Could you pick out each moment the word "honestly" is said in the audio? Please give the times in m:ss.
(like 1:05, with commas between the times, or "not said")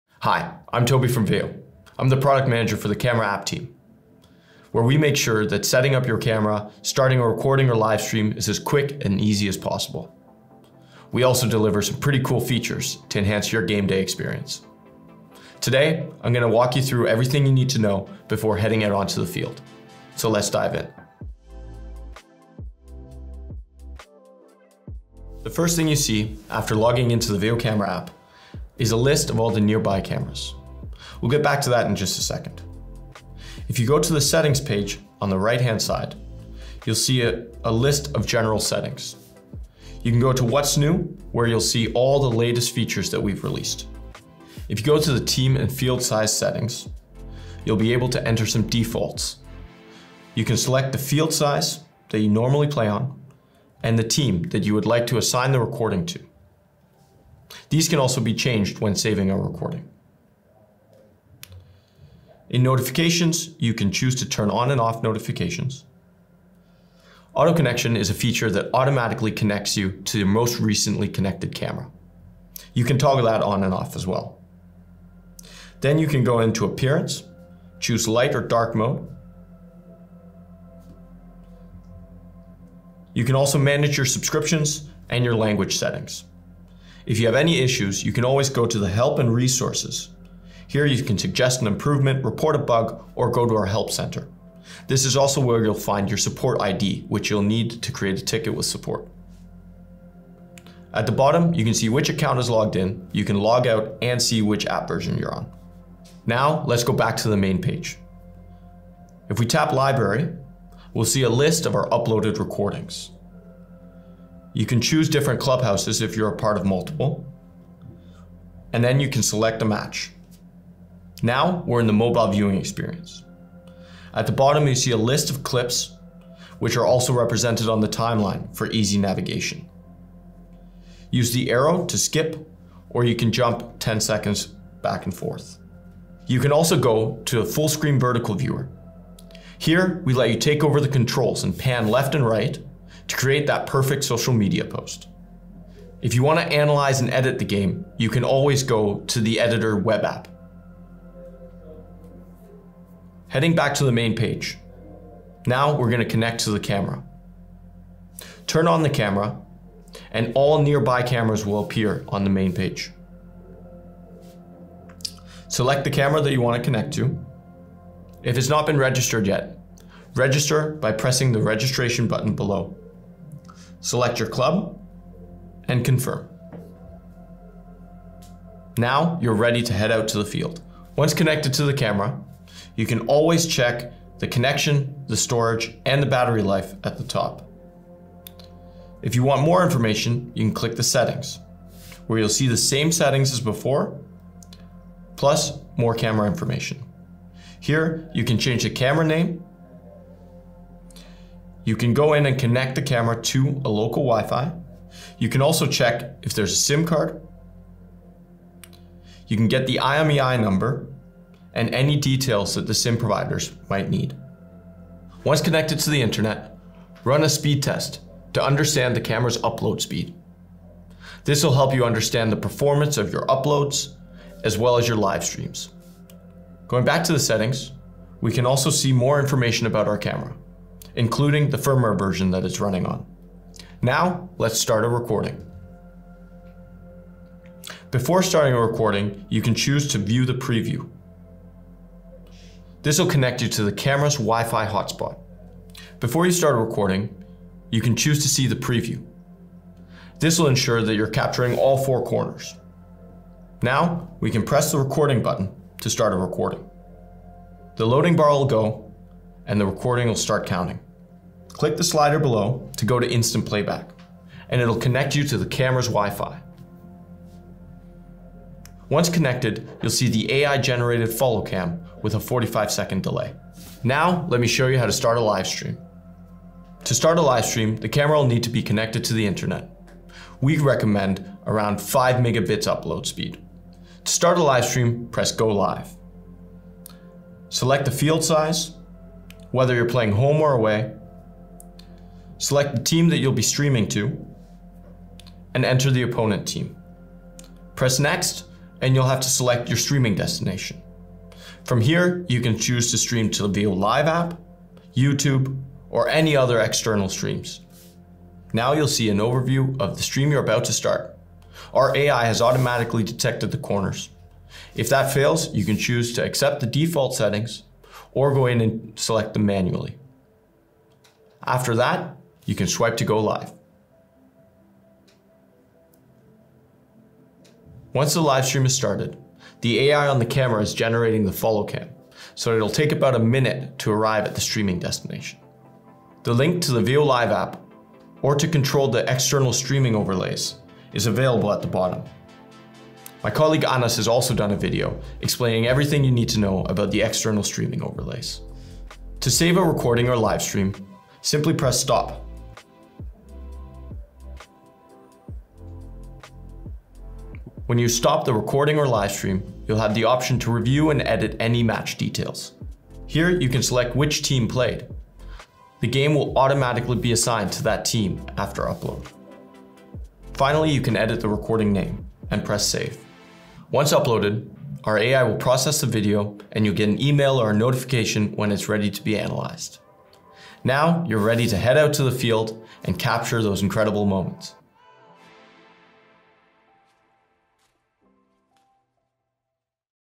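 not said.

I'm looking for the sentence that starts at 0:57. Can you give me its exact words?
These can also be changed when saving a recording.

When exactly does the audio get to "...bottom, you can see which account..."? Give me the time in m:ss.
1:41.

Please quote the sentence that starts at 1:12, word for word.
You can toggle that on and off as well.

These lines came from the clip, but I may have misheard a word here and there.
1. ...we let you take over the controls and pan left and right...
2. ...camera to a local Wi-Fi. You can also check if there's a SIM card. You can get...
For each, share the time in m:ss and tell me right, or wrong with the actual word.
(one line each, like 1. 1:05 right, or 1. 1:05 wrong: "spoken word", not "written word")
1. 2:20 right
2. 3:22 right.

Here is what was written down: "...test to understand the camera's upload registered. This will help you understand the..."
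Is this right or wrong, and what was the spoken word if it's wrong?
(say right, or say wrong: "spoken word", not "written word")
wrong: "speed", not "registered".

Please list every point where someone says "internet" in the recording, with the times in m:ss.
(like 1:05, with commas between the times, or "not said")
3:36, 4:39.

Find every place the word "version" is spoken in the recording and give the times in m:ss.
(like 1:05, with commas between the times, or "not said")
1:44, 3:51.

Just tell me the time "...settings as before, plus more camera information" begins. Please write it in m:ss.
3:12.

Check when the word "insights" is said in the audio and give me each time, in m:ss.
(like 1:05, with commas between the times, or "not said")
not said.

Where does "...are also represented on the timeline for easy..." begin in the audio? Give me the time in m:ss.
2:06.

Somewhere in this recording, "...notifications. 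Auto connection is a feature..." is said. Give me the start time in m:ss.
1:05.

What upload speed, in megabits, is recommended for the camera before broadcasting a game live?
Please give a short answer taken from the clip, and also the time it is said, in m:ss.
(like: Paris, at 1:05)
5 megabits, at 4:41.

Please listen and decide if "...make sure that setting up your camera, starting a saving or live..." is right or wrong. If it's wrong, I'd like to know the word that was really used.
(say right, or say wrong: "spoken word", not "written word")
wrong: "recording", not "saving".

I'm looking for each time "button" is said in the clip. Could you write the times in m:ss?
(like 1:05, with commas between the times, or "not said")
2:52, 4:15.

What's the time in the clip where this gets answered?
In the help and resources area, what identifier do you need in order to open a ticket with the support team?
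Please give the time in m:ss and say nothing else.
1:36.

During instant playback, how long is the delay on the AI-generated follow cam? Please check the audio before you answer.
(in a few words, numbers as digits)
45 seconds.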